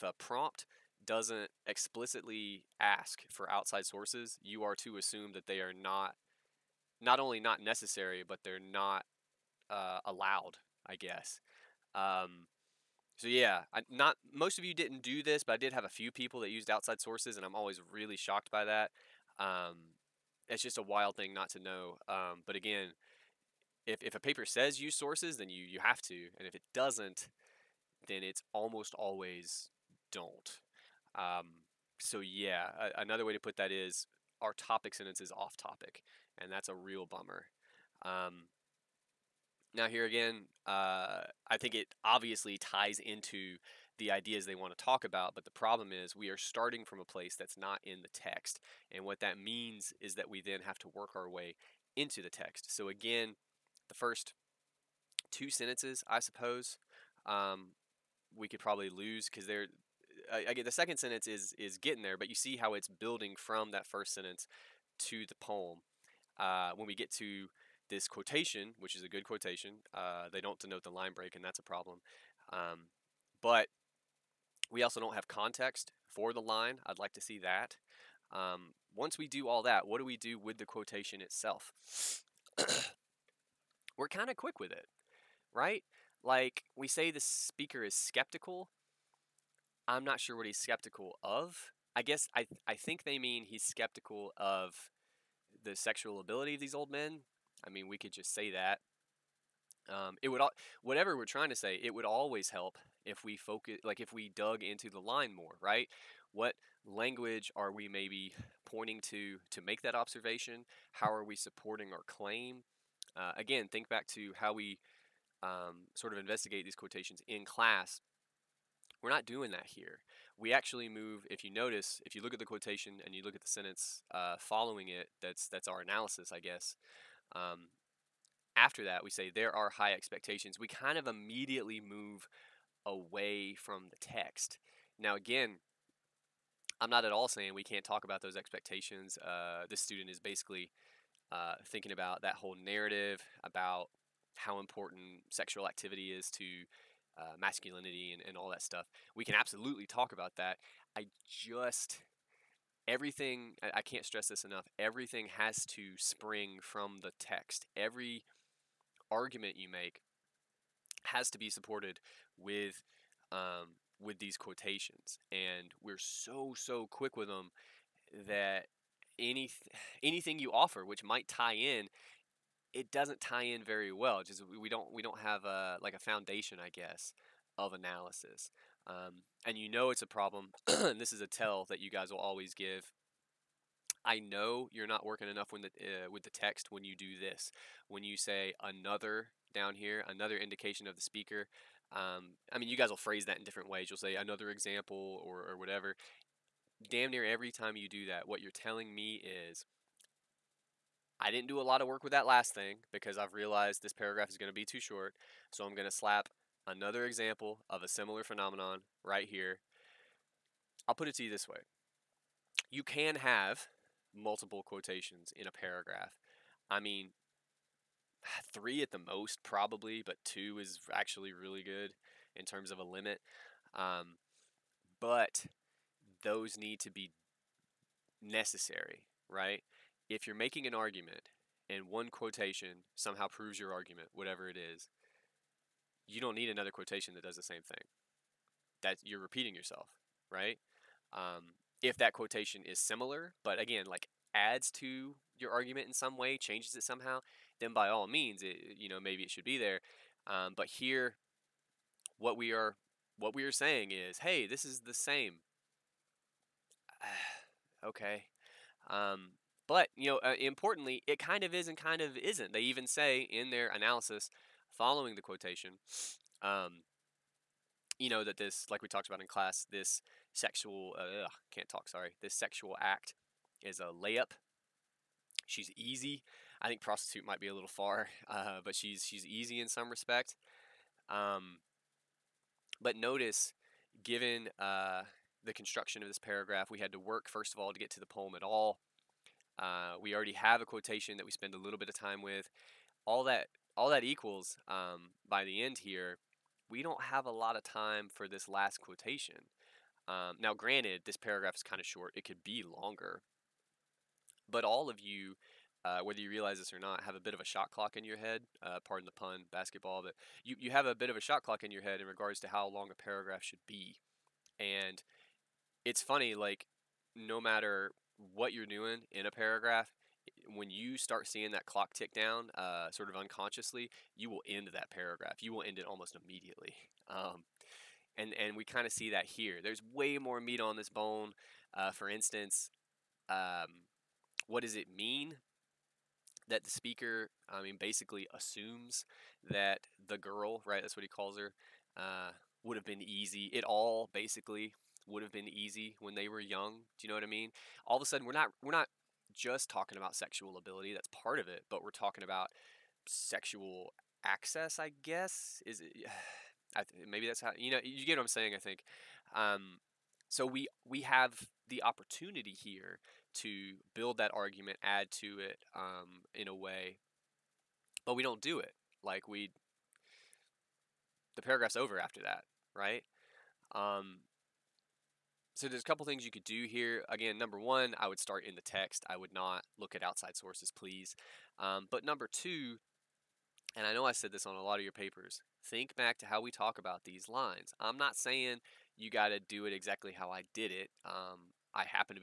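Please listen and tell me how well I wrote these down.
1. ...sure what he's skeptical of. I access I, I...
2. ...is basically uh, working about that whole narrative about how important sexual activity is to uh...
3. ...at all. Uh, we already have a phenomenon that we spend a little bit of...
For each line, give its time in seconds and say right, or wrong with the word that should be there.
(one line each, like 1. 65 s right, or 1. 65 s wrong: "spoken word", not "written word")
1. 90 s wrong: "guess", not "access"
2. 140 s wrong: "thinking", not "working"
3. 288 s wrong: "quotation", not "phenomenon".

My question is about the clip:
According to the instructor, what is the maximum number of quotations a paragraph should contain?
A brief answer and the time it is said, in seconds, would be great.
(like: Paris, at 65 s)
3, at 218 s.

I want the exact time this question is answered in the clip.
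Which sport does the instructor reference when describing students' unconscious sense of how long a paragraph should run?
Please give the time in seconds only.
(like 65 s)
309 s.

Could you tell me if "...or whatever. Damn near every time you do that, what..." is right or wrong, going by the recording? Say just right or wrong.
right.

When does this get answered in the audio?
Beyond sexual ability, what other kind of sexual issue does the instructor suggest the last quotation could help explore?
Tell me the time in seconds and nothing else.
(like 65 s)
353 s.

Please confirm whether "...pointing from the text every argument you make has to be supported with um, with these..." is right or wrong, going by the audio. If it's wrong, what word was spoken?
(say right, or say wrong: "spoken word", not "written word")
wrong: "spring", not "pointing".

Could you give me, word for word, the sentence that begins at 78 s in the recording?
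Um, once we do all that, what do we do with the quotation itself?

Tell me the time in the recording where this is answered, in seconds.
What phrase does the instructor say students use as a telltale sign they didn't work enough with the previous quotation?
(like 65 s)
190 s.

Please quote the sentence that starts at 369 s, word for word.
Like we, the paragraph's over after that, right?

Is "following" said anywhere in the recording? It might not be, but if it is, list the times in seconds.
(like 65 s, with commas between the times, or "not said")
124 s, 264 s.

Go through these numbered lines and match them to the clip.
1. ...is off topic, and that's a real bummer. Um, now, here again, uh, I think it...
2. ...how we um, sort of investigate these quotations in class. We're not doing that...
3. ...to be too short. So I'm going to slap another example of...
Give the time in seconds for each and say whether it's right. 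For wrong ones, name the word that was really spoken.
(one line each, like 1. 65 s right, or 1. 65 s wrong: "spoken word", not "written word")
1. 35 s right
2. 114 s right
3. 204 s right.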